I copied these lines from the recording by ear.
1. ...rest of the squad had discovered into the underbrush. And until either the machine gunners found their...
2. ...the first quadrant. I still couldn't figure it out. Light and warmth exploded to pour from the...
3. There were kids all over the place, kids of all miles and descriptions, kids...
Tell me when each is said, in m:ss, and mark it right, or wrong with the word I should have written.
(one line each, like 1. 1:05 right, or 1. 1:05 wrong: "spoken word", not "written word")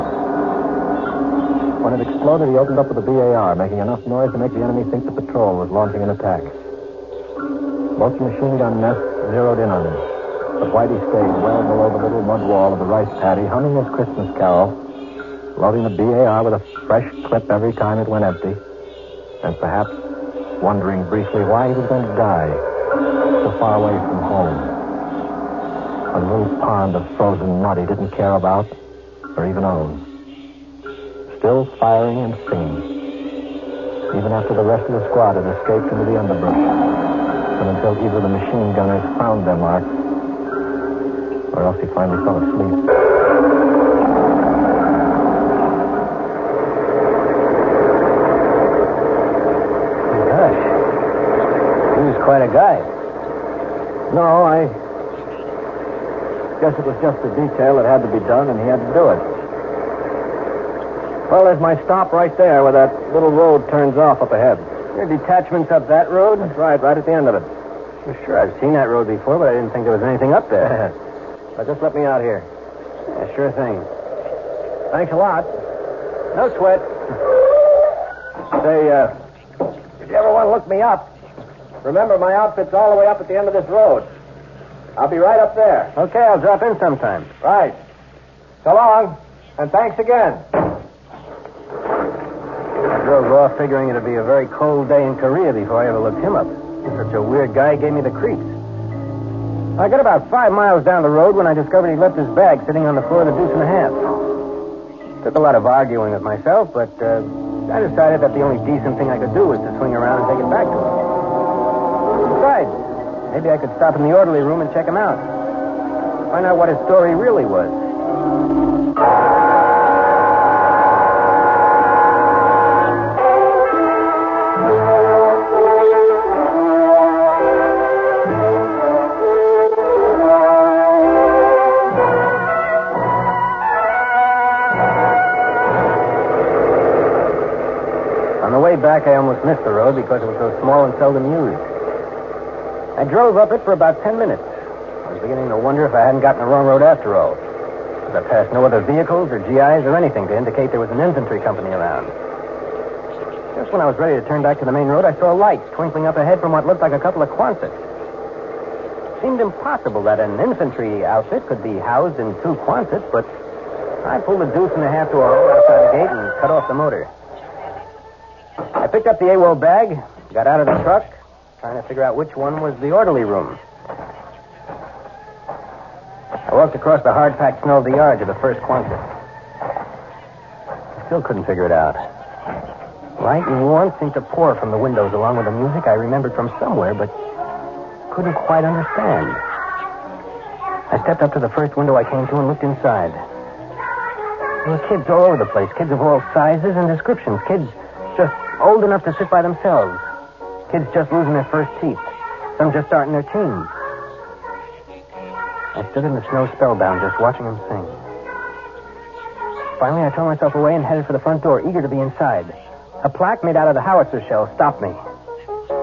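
1. 0:34 wrong: "escaped", not "discovered"
2. 2:58 wrong: "seemed", not "exploded"
3. 3:14 wrong: "sizes", not "miles".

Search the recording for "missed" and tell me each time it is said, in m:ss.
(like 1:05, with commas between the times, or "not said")
2:19.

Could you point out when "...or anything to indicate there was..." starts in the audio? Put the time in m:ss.
2:29.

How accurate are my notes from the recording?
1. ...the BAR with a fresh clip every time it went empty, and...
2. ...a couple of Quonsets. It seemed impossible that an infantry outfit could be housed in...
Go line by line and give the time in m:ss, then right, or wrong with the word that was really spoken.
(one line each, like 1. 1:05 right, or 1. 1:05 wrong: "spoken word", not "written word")
1. 0:15 right
2. 2:36 right.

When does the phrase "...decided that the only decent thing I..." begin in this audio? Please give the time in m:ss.
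1:47.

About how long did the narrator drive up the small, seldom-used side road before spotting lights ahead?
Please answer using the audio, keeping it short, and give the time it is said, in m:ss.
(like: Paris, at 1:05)
10 minutes, at 2:24.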